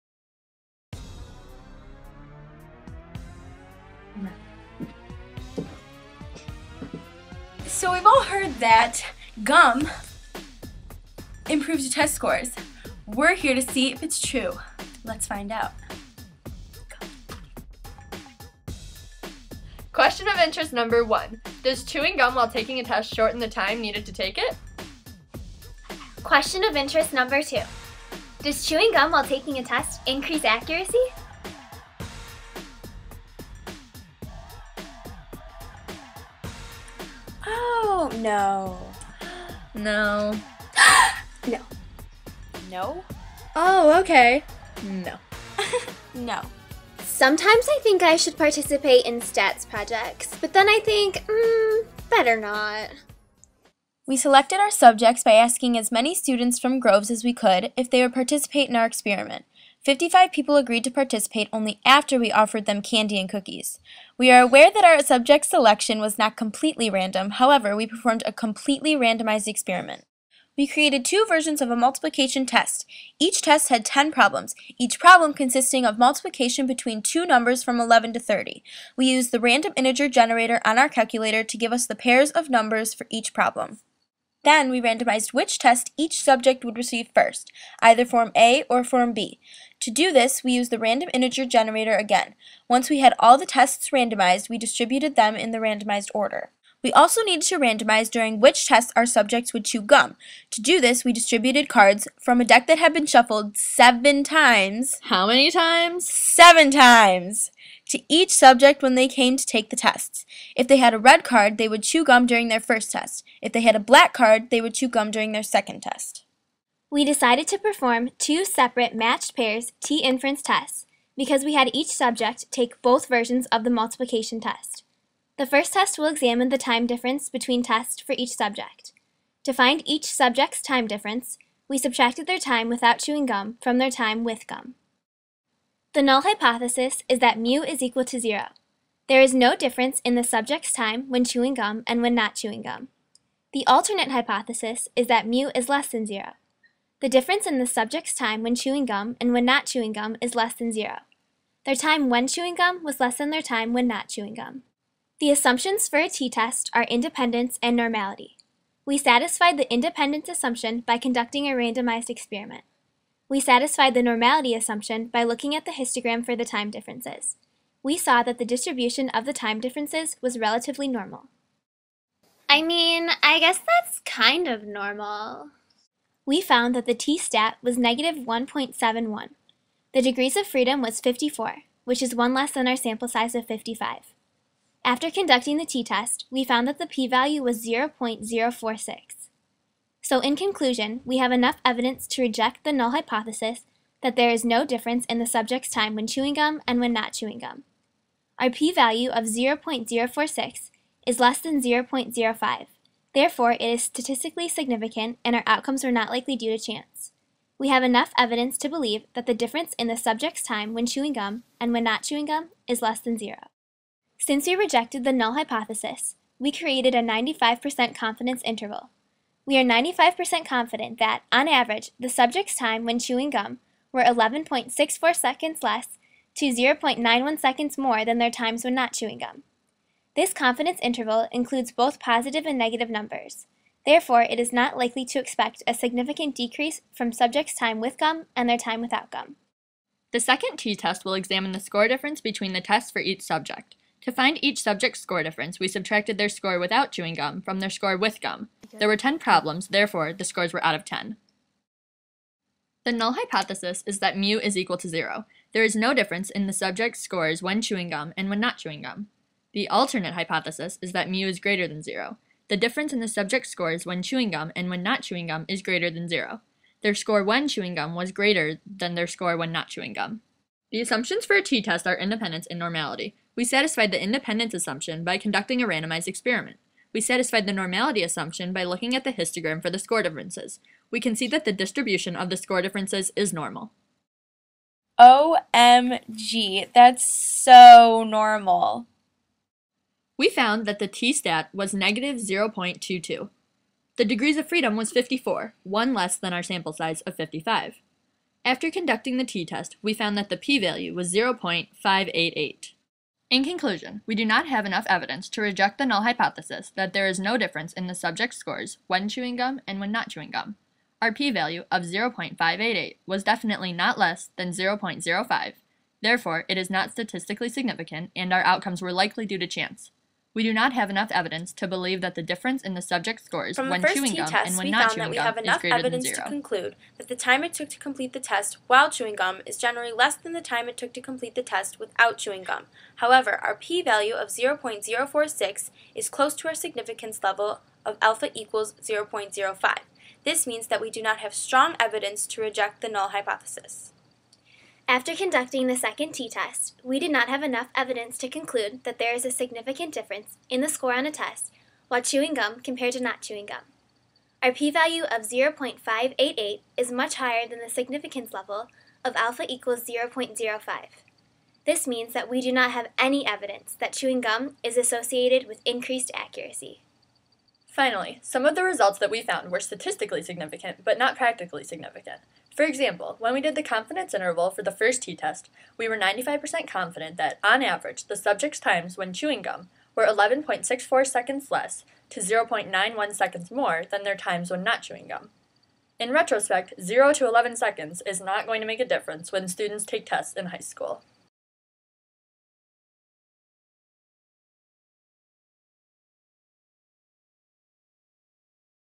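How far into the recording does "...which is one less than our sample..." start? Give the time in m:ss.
3:01.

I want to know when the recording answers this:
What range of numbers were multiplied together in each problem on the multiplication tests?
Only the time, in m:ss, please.
1:17.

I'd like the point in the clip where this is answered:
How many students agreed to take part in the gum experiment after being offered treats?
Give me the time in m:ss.
0:59.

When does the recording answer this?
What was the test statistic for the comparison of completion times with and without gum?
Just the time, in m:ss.
2:57.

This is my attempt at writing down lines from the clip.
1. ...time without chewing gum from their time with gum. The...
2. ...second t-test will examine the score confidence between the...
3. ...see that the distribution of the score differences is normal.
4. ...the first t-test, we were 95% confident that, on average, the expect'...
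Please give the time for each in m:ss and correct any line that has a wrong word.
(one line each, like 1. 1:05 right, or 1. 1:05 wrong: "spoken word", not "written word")
1. 2:12 right
2. 4:00 wrong: "difference", not "confidence"
3. 4:41 right
4. 6:14 wrong: "subjects", not "expect".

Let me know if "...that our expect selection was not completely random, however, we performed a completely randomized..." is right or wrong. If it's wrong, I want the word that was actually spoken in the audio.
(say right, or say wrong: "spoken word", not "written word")
wrong: "subject", not "expect".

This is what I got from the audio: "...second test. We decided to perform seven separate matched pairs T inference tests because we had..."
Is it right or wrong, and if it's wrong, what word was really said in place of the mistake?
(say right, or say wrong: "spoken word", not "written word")
wrong: "two", not "seven".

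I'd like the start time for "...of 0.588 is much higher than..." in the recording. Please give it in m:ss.
5:55.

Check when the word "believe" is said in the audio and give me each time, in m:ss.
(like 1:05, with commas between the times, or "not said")
3:28, 5:21.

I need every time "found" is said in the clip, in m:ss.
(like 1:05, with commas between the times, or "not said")
2:56, 3:06, 4:50, 4:59, 6:09.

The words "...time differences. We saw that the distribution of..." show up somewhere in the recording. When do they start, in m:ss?
2:46.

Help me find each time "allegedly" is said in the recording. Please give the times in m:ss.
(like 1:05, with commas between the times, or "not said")
not said.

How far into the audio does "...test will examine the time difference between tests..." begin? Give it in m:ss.
2:05.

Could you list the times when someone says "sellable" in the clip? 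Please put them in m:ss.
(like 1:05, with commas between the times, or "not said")
not said.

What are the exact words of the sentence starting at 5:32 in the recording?
However, our p-value of 0.046 is close to our significance level of alpha equals 0.05.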